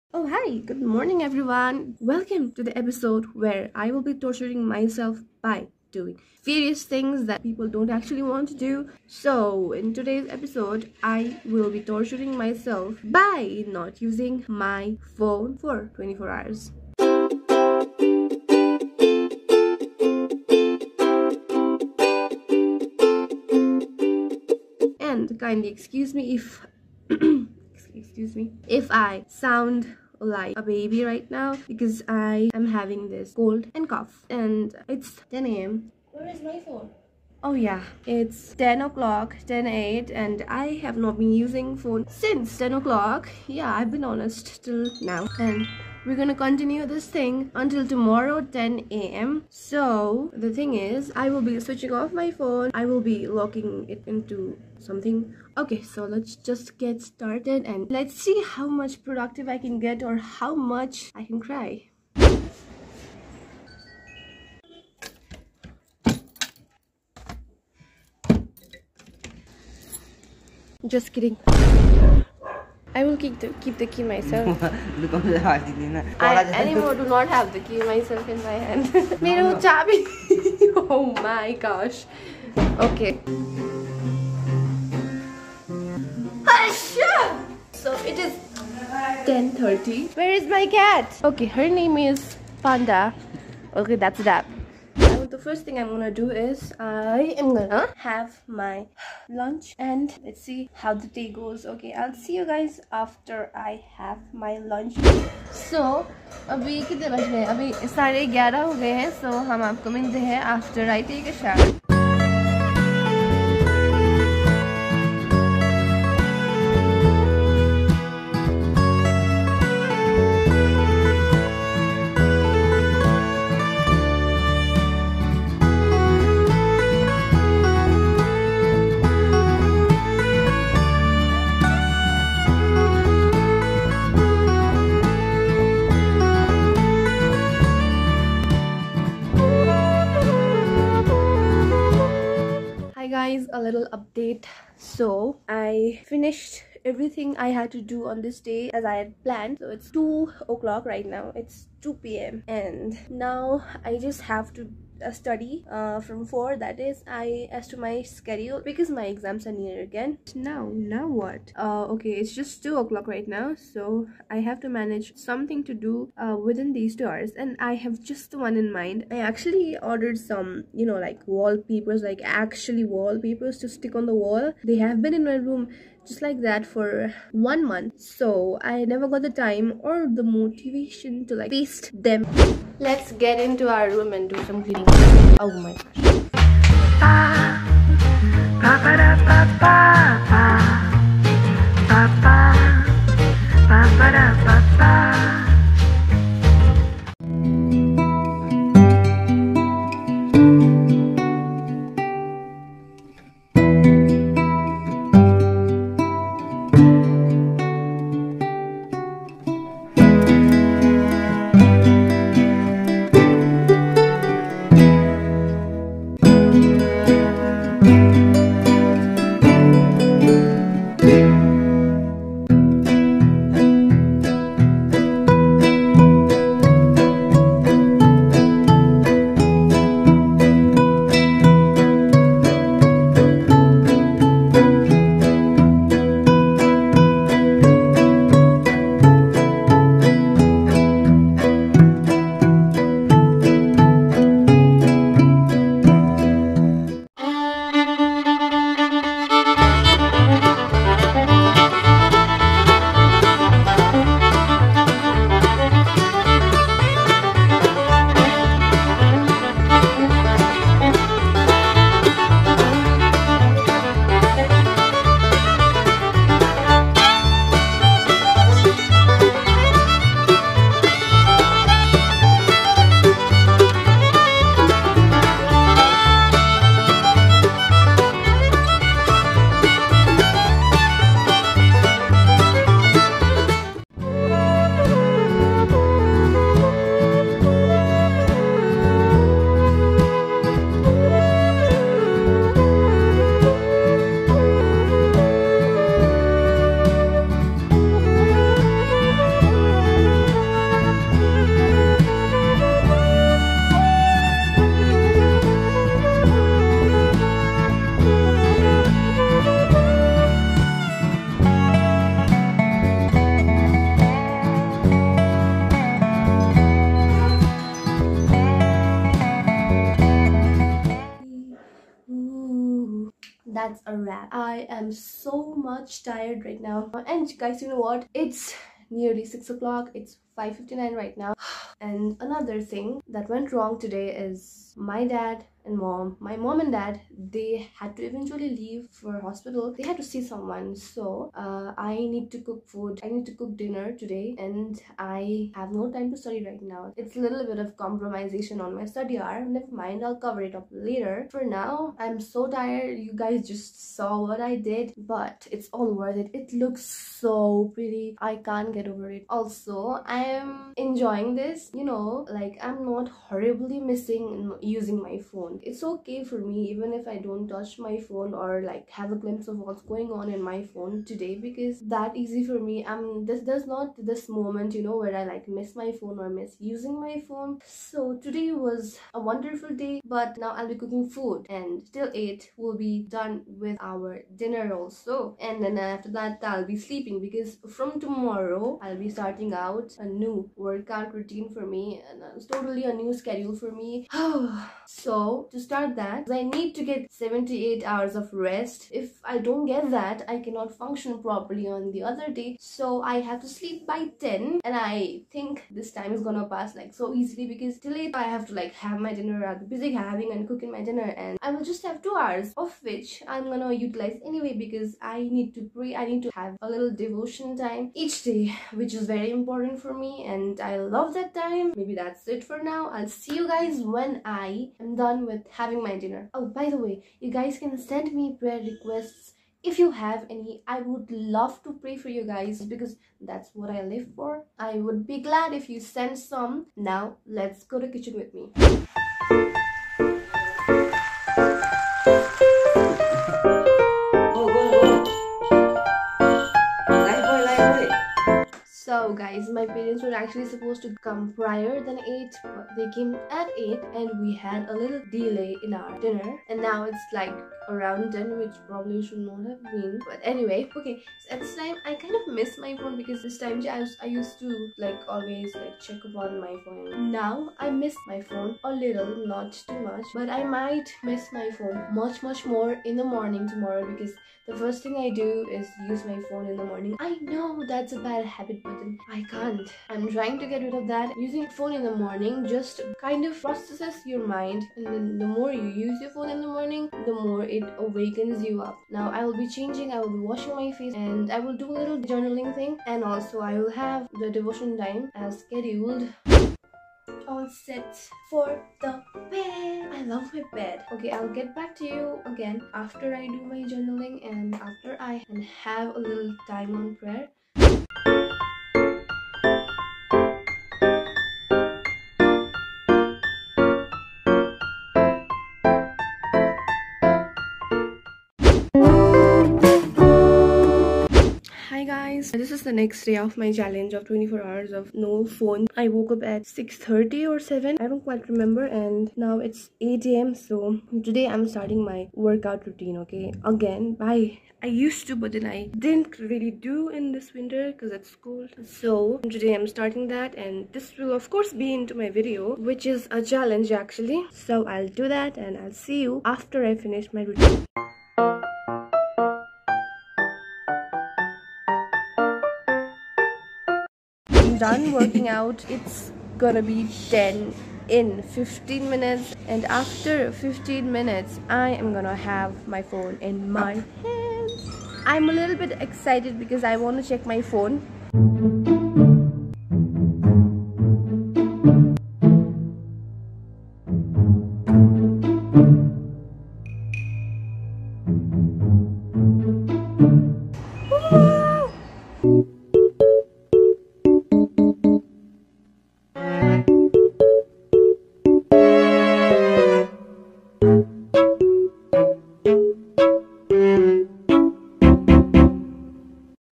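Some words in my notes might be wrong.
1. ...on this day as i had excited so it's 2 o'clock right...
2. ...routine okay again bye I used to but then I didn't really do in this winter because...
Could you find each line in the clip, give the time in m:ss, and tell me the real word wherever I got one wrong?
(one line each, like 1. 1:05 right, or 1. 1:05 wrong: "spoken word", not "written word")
1. 2:28 wrong: "planned", not "excited"
2. 8:52 right.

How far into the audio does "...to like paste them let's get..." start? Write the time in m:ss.
3:01.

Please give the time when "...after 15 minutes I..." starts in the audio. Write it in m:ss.
9:19.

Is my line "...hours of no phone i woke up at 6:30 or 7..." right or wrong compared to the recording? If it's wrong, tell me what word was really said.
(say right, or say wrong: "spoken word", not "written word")
right.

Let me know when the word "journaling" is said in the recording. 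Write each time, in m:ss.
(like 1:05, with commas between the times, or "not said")
8:11, 8:23.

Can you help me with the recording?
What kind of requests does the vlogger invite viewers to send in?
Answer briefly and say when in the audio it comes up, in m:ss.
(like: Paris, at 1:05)
prayer requests, at 7:08.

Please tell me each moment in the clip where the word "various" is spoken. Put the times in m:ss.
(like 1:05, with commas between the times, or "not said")
0:06.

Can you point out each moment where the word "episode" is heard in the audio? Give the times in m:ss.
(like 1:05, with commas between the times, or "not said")
0:02, 0:10.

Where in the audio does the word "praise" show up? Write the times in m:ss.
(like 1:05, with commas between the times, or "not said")
not said.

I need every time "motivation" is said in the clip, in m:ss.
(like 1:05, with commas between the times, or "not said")
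3:00.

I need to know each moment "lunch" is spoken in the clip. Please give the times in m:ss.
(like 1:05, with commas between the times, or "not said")
1:39, 1:44.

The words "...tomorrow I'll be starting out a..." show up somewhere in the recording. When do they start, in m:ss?
6:27.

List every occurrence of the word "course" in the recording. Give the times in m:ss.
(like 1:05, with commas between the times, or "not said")
9:01.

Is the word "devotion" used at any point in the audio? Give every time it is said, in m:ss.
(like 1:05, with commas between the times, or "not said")
6:56, 8:14.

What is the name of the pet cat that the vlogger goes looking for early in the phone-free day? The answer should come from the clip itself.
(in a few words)
Panda.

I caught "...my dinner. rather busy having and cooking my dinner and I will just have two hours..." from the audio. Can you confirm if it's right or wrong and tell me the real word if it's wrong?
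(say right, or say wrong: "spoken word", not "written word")
right.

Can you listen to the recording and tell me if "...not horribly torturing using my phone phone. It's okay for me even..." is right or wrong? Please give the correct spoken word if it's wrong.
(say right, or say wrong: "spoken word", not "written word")
wrong: "missing", not "torturing".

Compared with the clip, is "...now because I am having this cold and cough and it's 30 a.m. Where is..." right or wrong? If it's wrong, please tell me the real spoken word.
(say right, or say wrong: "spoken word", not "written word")
wrong: "10", not "30".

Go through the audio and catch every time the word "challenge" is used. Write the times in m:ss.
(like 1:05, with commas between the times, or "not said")
8:43, 9:03.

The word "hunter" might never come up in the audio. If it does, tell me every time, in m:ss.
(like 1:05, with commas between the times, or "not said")
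not said.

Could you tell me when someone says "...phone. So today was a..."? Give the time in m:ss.
6:17.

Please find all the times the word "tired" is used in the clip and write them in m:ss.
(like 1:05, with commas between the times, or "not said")
5:26, 5:52.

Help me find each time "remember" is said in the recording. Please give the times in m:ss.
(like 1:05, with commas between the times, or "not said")
8:48.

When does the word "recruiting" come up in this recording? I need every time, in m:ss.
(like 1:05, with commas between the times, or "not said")
not said.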